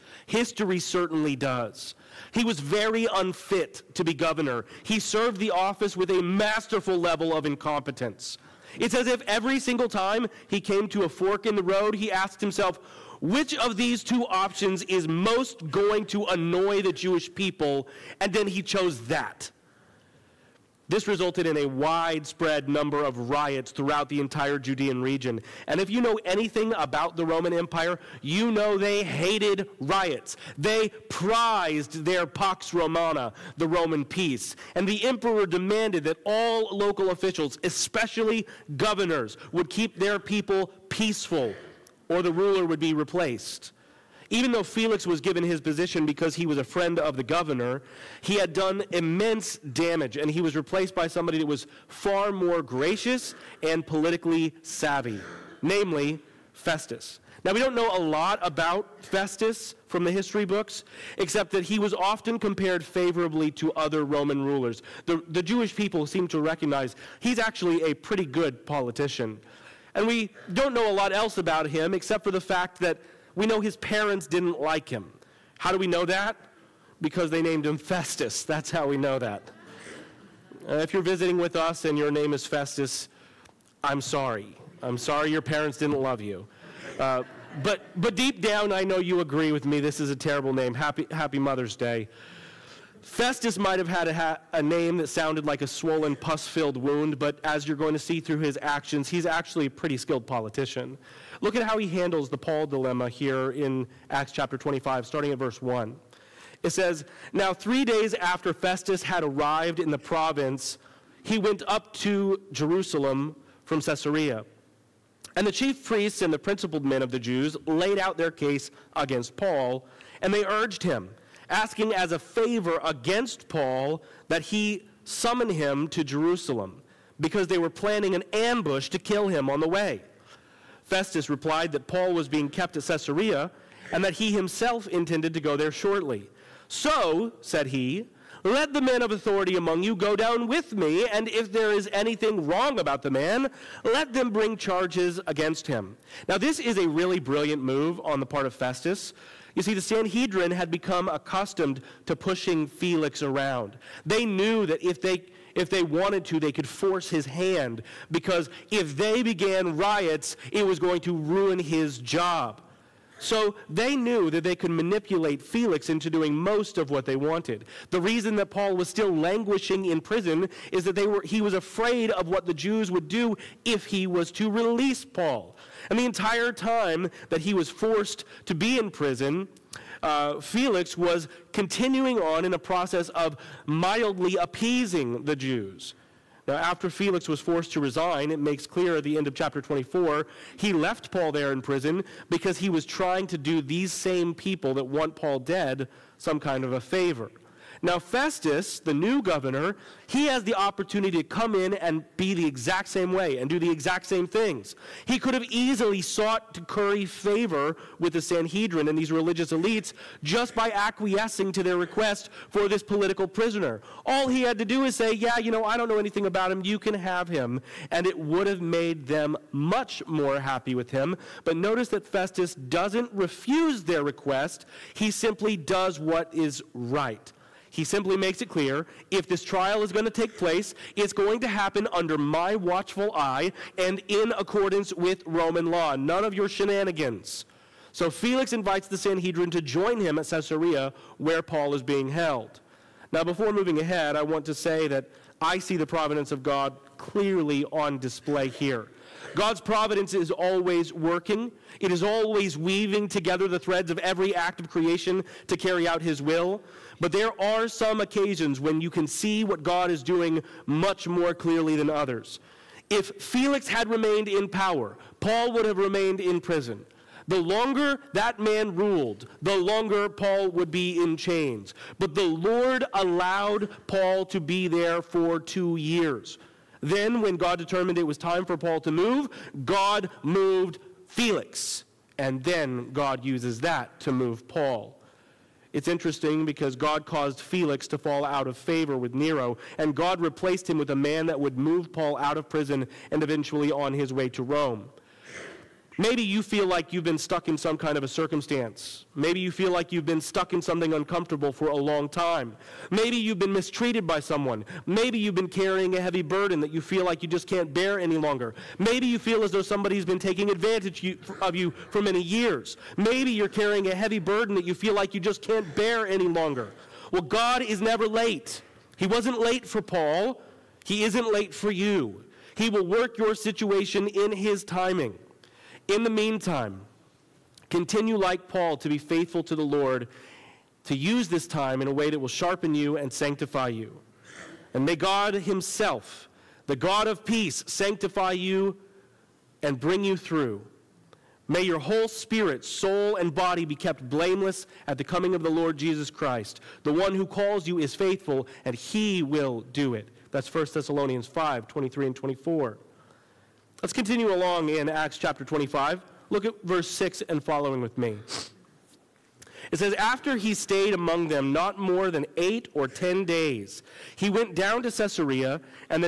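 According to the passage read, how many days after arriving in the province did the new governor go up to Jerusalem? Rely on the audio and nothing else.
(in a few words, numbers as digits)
3.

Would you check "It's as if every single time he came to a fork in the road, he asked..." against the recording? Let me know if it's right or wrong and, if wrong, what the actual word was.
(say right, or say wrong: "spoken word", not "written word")
right.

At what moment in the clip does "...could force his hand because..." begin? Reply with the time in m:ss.
2:36.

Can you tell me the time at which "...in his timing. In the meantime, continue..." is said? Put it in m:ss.
5:24.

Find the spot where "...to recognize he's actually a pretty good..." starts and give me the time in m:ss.
1:06.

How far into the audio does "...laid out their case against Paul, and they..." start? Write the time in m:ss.
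1:57.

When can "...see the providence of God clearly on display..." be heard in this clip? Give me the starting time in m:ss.
4:05.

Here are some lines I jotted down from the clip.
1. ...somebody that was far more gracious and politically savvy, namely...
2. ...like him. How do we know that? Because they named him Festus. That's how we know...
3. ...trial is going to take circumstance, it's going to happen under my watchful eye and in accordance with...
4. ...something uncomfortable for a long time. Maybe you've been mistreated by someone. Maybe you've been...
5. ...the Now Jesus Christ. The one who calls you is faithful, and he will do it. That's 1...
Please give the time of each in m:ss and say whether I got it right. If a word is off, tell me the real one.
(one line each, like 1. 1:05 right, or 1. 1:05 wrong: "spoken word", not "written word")
1. 0:51 right
2. 1:14 right
3. 3:49 wrong: "place", not "circumstance"
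4. 5:00 right
5. 5:45 wrong: "Lord", not "Now".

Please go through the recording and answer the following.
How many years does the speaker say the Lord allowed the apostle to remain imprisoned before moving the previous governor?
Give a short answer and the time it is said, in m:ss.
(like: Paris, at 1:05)
2, at 4:35.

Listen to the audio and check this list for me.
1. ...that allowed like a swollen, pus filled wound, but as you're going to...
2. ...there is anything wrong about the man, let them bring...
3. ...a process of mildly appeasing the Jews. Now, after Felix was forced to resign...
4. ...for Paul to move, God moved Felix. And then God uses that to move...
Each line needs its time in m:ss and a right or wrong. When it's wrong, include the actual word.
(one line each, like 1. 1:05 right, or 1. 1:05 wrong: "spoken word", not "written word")
1. 1:34 wrong: "sounded", not "allowed"
2. 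2:21 right
3. 3:02 right
4. 4:38 right.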